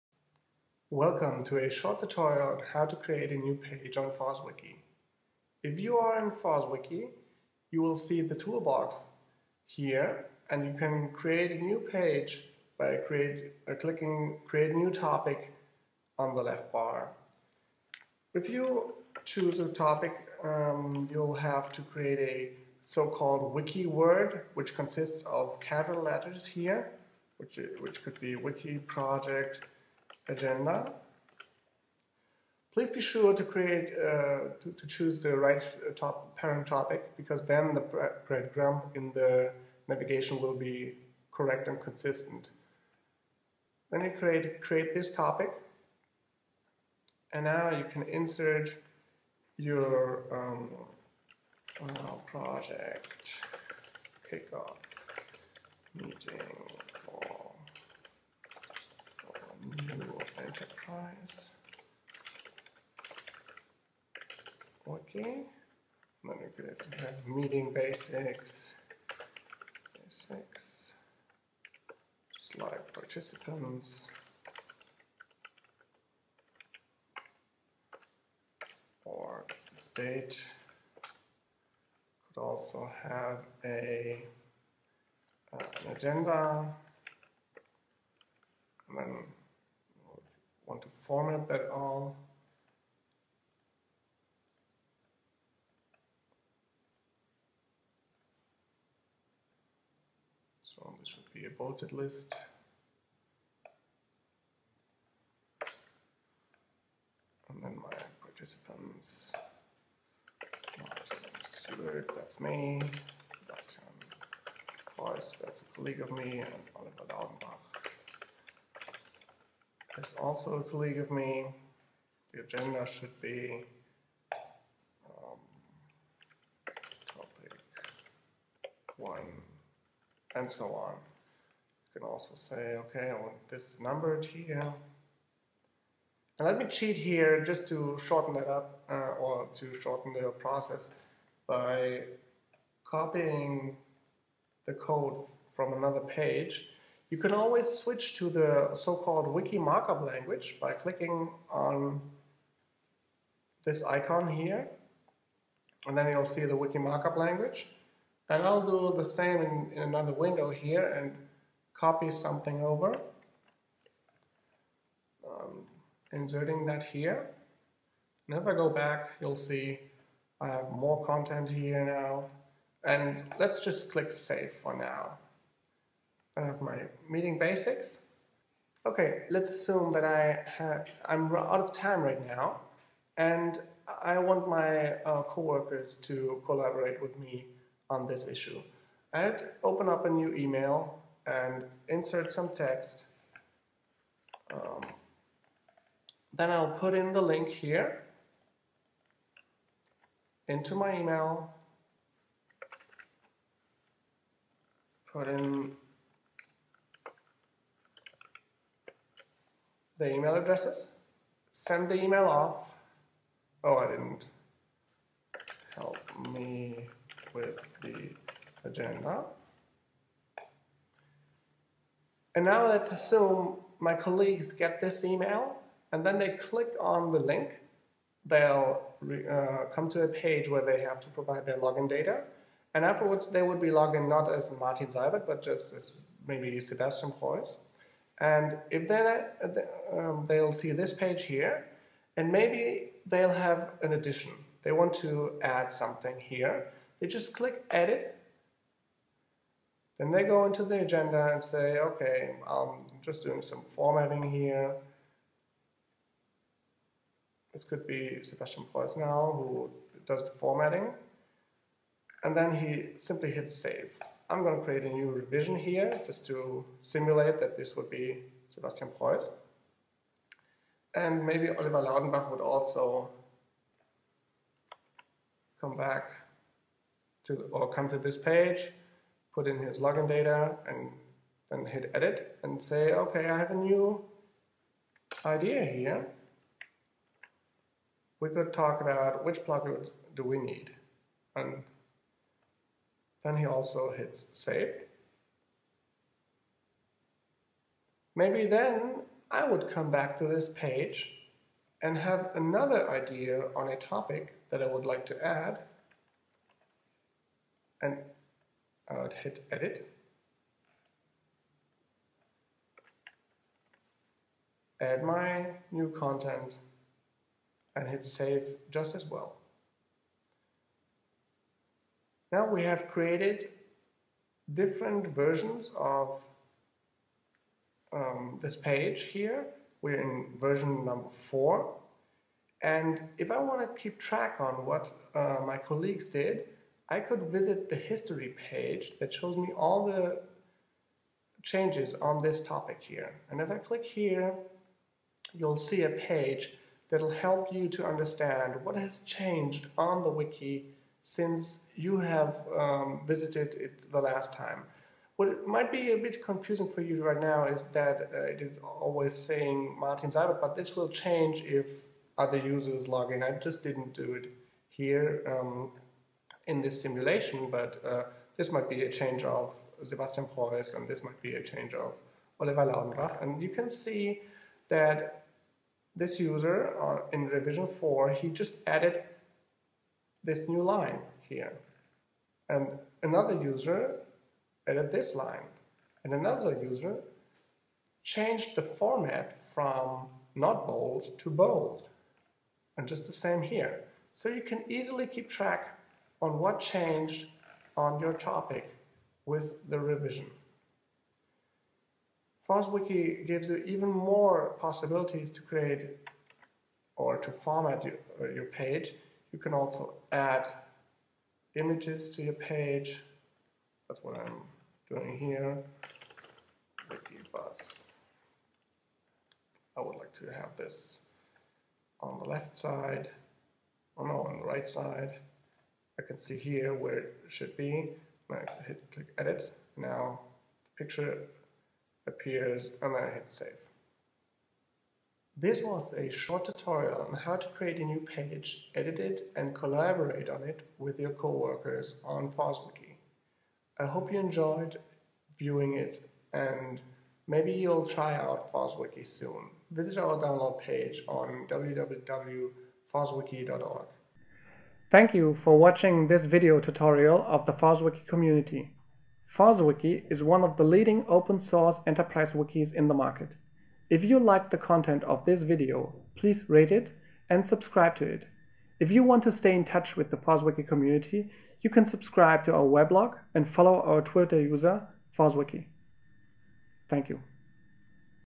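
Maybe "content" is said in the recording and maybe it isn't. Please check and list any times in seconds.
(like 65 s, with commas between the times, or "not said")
171 s, 315 s, 464 s.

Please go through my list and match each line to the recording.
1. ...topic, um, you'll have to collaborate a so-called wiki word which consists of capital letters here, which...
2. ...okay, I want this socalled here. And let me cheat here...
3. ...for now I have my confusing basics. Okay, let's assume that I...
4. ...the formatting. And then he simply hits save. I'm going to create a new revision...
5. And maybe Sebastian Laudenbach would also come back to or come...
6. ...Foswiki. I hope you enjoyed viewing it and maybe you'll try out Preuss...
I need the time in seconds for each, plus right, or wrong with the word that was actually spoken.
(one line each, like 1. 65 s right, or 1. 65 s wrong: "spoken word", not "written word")
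1. 19 s wrong: "create", not "collaborate"
2. 132 s wrong: "numbered", not "socalled"
3. 174 s wrong: "meeting", not "confusing"
4. 260 s right
5. 270 s wrong: "Oliver", not "Sebastian"
6. 442 s wrong: "Foswiki", not "Preuss".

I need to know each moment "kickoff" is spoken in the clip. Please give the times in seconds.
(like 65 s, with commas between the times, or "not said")
54 s.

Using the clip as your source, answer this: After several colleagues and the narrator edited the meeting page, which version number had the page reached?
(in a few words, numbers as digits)
4.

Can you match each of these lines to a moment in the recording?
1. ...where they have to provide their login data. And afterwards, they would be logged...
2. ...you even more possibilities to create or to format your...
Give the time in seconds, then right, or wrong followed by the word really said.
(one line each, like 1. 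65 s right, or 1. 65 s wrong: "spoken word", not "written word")
1. 230 s right
2. 403 s right.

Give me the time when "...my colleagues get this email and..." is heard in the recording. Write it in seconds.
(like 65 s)
223 s.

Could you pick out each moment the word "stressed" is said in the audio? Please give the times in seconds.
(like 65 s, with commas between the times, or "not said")
not said.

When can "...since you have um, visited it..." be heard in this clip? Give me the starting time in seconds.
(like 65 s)
351 s.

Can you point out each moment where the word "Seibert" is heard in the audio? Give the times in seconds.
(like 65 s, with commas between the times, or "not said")
111 s, 234 s, 360 s.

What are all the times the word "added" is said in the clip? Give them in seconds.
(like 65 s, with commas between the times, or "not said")
378 s, 384 s.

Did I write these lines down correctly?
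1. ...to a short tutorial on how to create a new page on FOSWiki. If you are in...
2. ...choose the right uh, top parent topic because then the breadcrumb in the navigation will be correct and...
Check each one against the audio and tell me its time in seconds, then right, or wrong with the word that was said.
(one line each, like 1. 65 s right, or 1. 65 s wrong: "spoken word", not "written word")
1. 1 s right
2. 34 s right.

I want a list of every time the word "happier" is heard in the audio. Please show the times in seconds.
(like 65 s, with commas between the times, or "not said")
not said.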